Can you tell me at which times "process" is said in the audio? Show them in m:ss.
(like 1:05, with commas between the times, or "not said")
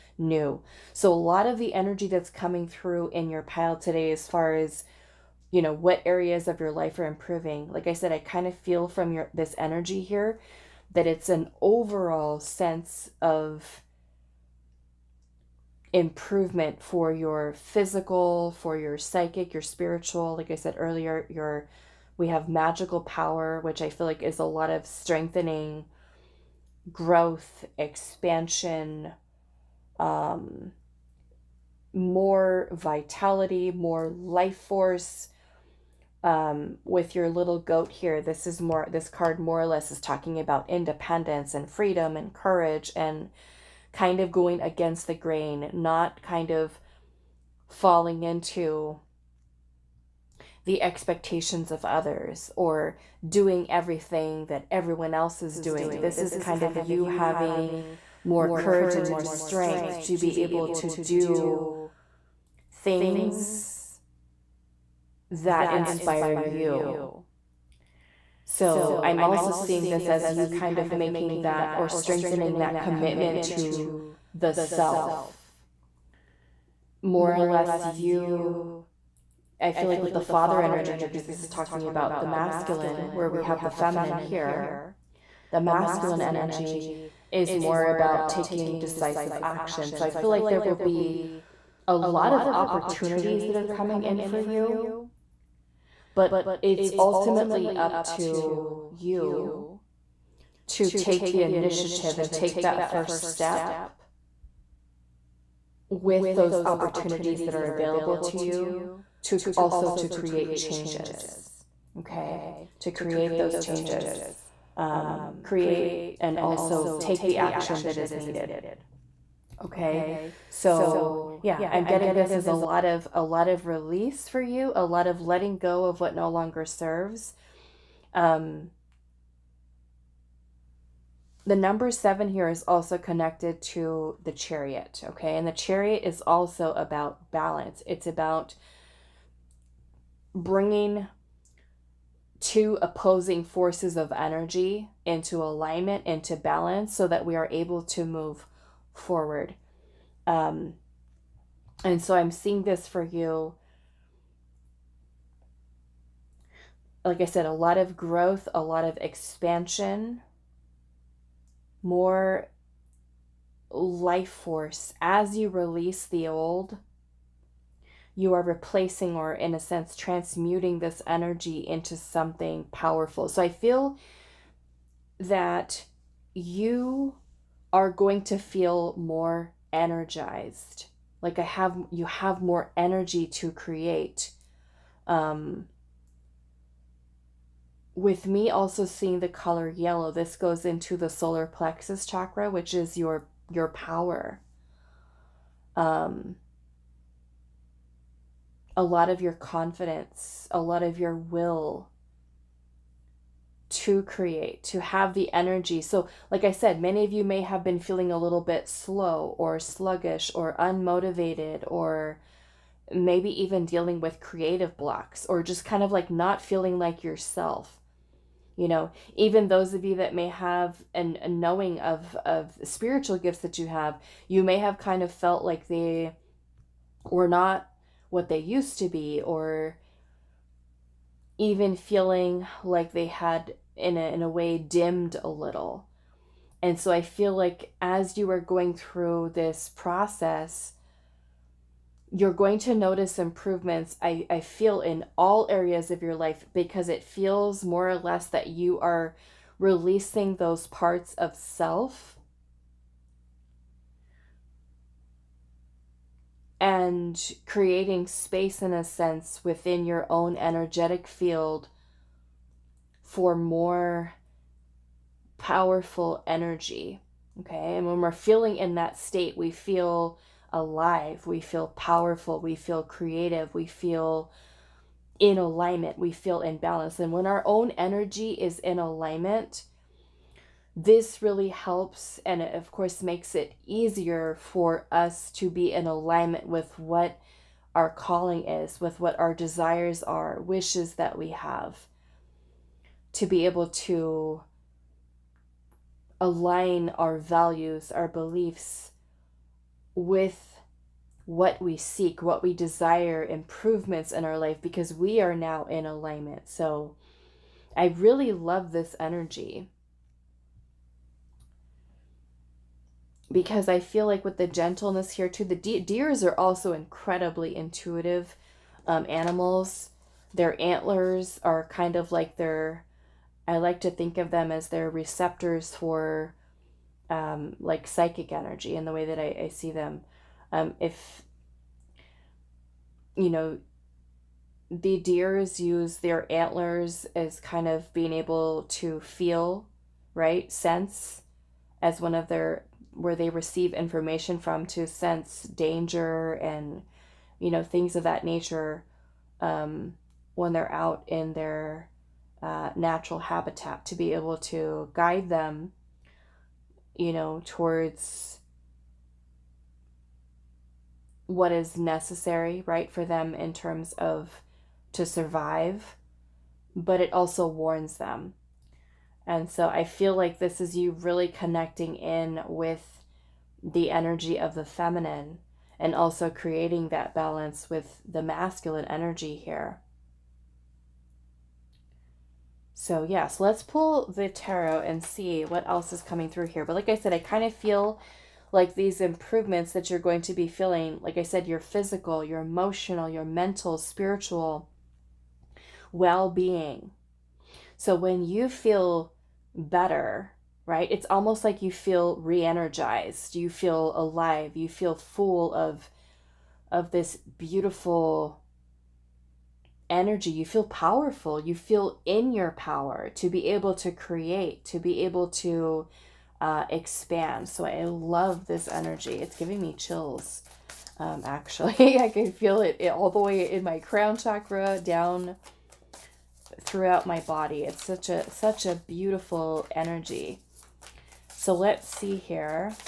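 3:59.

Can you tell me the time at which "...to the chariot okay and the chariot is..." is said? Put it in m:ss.
2:13.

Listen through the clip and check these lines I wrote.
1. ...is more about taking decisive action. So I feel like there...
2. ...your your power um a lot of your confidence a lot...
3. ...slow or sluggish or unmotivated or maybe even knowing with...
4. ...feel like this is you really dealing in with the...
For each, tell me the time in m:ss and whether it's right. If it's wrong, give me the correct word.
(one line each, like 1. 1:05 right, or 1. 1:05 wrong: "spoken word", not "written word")
1. 1:27 right
2. 3:12 right
3. 3:28 wrong: "dealing", not "knowing"
4. 6:09 wrong: "connecting", not "dealing".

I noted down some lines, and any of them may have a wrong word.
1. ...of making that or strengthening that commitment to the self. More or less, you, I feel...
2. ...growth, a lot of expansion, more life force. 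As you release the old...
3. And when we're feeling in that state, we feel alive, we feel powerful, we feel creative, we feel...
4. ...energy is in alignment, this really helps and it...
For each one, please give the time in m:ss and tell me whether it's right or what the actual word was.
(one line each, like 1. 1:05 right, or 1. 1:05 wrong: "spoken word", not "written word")
1. 1:10 right
2. 2:37 right
3. 4:27 right
4. 4:37 right.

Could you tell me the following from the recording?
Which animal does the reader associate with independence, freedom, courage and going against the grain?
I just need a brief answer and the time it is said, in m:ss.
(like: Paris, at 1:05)
Goat, at 0:37.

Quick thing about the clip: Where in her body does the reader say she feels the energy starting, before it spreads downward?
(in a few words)
Crown chakra.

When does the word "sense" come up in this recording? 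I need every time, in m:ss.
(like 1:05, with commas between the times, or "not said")
0:12, 2:49, 4:18, 5:40, 5:44.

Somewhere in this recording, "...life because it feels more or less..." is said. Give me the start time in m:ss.
4:06.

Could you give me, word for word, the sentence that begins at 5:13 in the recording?
Because I feel like with the gentleness here, too, the de- deers are also incredibly intuitive um, animals.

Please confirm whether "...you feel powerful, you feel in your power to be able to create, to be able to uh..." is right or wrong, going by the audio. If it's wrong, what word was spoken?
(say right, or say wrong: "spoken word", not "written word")
right.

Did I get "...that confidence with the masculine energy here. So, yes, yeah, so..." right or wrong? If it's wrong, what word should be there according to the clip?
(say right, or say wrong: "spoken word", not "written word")
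wrong: "balance", not "confidence".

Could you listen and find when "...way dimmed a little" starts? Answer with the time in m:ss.
3:54.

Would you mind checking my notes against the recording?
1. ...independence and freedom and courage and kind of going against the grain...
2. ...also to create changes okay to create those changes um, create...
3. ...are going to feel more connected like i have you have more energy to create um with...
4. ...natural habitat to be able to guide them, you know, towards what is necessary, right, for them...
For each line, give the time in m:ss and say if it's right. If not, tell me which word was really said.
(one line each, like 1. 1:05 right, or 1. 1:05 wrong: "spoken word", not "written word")
1. 0:40 right
2. 1:49 right
3. 2:57 wrong: "energized", not "connected"
4. 5:52 right.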